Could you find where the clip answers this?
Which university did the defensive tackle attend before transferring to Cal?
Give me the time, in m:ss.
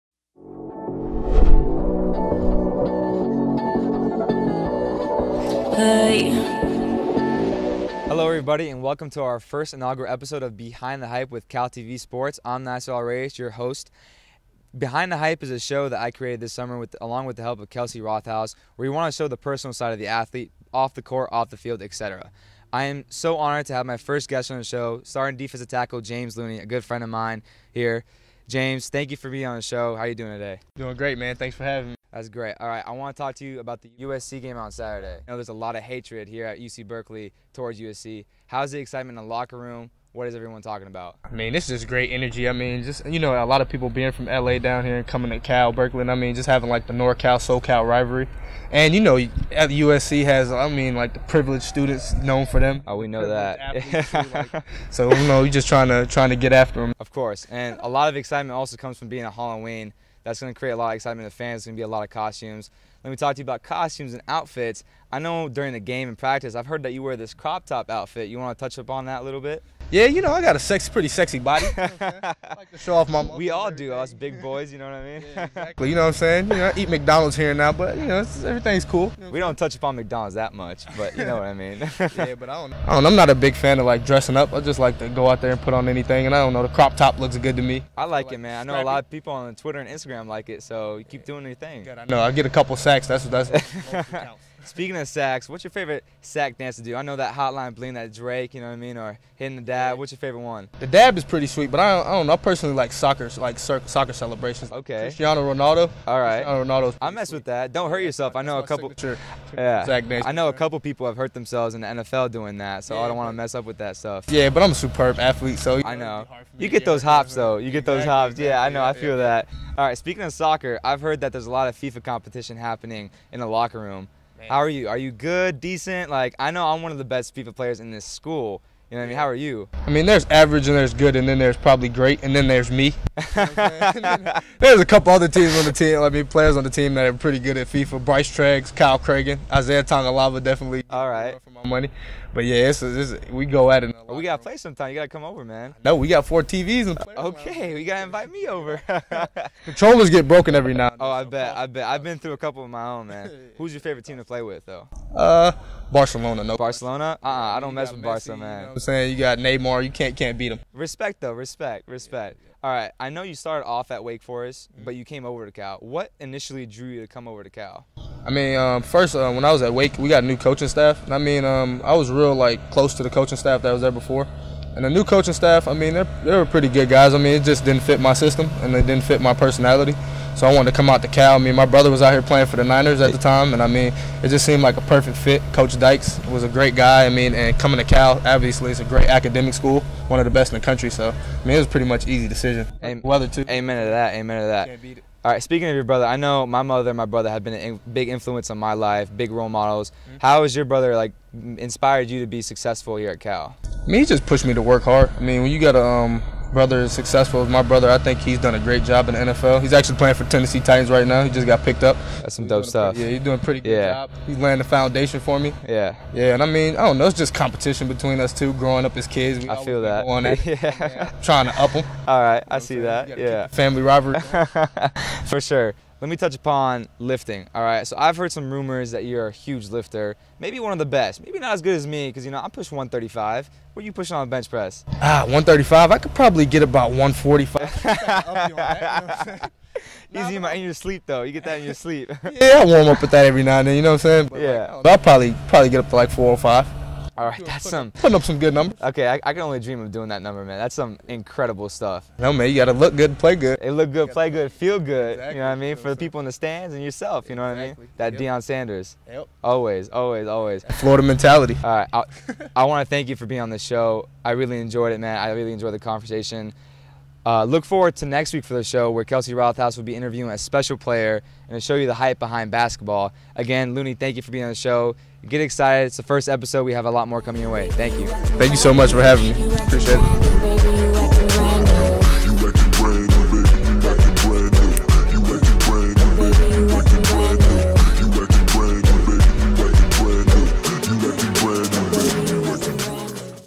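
2:44.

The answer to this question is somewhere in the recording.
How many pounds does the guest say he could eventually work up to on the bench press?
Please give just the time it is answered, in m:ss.
4:06.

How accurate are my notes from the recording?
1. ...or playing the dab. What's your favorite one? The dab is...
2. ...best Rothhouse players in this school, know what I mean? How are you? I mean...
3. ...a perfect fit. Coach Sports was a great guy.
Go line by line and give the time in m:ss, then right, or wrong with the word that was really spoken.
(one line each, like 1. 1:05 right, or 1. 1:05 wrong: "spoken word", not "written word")
1. 1:38 wrong: "hitting", not "playing"
2. 2:07 wrong: "FIFA", not "Rothhouse"
3. 3:04 wrong: "Dykes", not "Sports".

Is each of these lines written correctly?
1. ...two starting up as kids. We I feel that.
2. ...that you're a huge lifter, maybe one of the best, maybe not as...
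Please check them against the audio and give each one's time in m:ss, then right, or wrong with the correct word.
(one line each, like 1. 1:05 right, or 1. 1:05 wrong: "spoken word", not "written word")
1. 3:38 wrong: "growing", not "starting"
2. 3:48 right.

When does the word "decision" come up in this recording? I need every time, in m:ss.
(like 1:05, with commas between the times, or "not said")
3:12.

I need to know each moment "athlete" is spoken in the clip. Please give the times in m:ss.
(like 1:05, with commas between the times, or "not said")
0:20, 1:55.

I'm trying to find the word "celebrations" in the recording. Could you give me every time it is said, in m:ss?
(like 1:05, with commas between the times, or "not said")
1:44.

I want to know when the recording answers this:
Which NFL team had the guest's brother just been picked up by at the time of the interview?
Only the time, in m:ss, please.
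3:30.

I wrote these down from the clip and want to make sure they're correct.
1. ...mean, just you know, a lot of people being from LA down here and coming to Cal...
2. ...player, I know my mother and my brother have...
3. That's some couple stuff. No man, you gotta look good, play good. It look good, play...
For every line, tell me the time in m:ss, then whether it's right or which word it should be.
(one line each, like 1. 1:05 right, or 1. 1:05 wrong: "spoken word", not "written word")
1. 0:42 right
2. 3:15 wrong: "brother", not "player"
3. 4:10 wrong: "incredible", not "couple".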